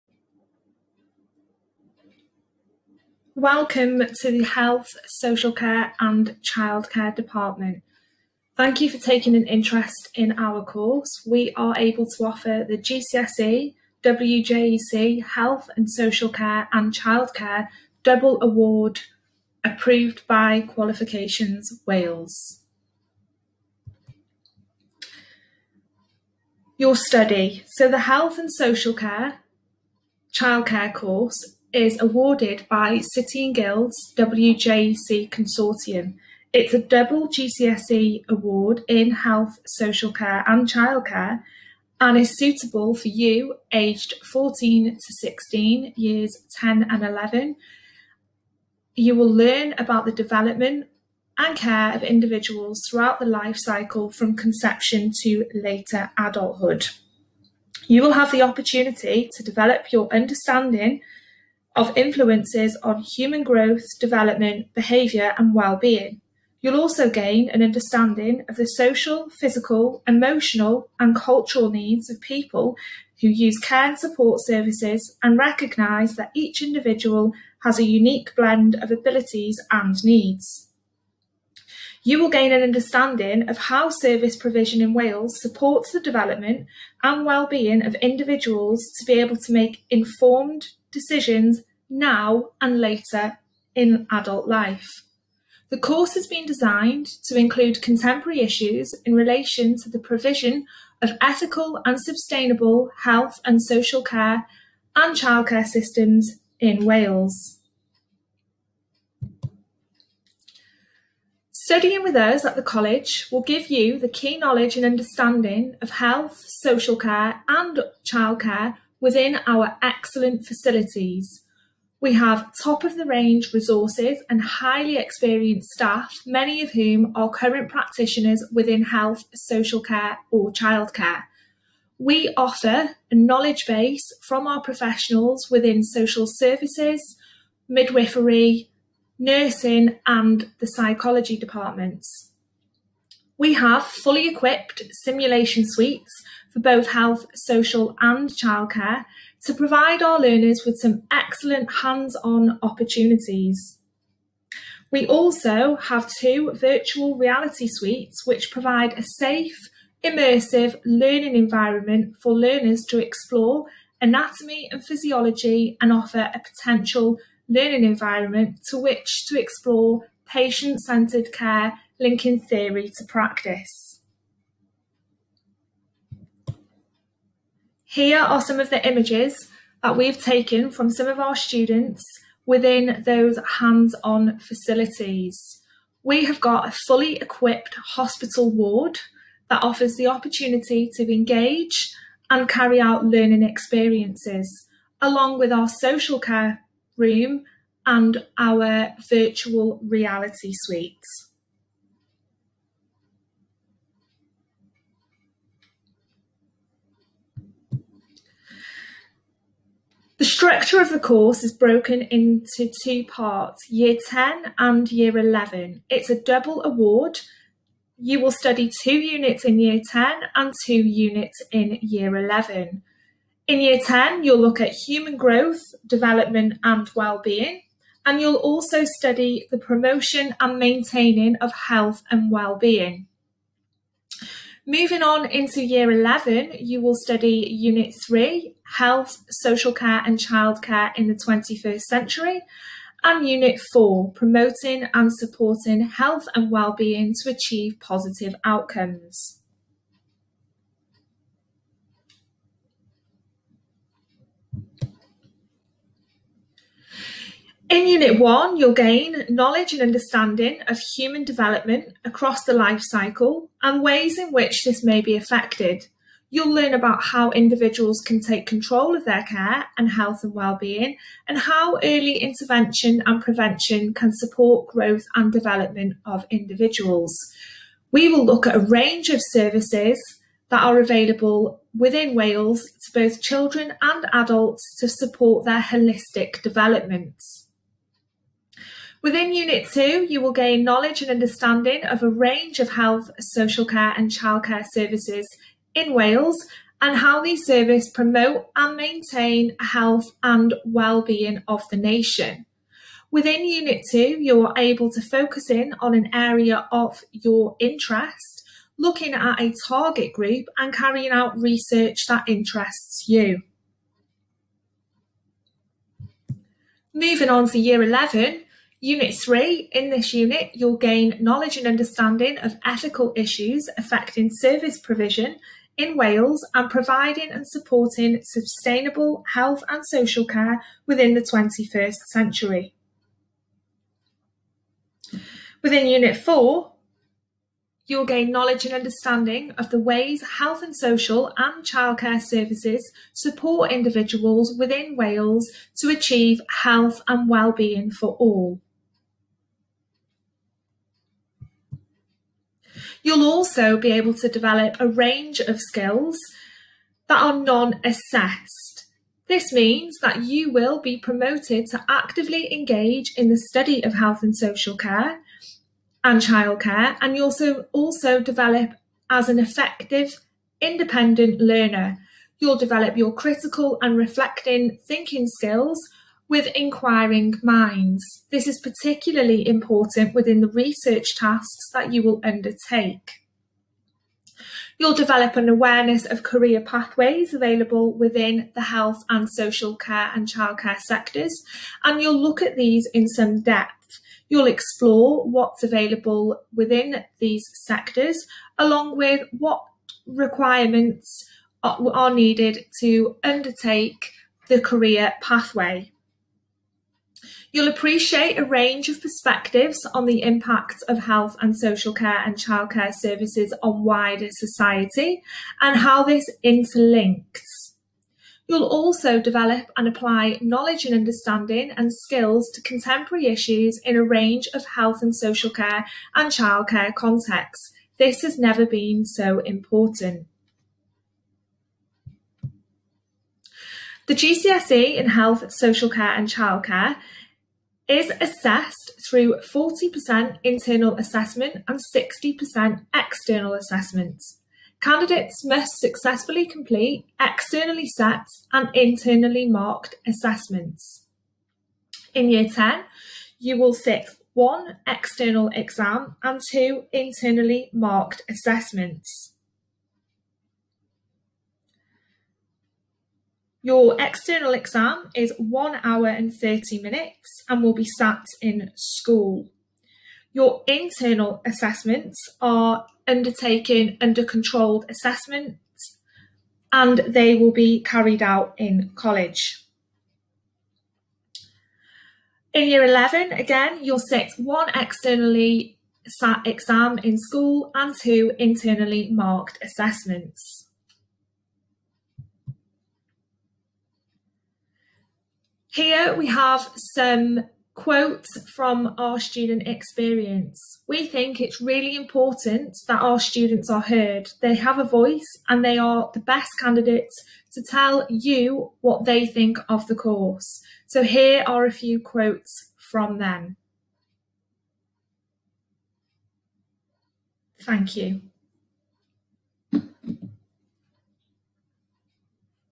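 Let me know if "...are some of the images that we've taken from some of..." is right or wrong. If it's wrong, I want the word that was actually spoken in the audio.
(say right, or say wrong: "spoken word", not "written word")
right.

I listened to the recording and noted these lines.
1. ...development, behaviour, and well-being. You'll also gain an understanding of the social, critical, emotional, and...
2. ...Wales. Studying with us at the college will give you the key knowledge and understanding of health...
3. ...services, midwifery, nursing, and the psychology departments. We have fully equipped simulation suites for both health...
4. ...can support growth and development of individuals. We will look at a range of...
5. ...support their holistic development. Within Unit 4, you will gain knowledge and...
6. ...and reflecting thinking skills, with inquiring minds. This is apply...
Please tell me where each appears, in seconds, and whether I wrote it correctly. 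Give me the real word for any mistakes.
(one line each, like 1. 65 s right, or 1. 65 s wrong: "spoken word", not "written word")
1. 63 s wrong: "physical", not "critical"
2. 106 s right
3. 136 s right
4. 273 s right
5. 284 s wrong: "2", not "4"
6. 373 s wrong: "particularly", not "apply".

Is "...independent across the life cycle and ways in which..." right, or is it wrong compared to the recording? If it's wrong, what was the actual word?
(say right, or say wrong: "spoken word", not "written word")
wrong: "development", not "independent".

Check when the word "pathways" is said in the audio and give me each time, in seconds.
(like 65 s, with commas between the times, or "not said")
386 s, 405 s.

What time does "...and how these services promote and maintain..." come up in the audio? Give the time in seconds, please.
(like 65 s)
296 s.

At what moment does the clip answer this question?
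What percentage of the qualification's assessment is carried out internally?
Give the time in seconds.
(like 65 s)
439 s.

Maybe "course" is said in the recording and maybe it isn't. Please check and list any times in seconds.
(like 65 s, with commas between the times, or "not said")
10 s, 30 s, 95 s, 210 s, 509 s.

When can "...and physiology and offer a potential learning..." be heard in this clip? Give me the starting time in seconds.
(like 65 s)
164 s.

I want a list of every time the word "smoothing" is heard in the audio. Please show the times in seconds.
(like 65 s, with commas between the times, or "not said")
not said.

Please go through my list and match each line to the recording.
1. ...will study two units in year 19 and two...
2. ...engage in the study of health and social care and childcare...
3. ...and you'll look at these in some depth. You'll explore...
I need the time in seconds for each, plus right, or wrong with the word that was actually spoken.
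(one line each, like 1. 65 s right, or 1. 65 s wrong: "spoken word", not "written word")
1. 218 s wrong: "10", not "19"
2. 362 s right
3. 391 s right.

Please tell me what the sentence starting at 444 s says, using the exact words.
Candidates must successfully complete externally set and internally marked assessments.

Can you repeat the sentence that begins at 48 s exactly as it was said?
You will learn about the development and care of individuals throughout the life cycle from conception to later adulthood.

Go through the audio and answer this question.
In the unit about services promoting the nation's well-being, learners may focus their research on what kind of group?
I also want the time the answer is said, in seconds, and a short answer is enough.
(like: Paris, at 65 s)
Target group, at 309 s.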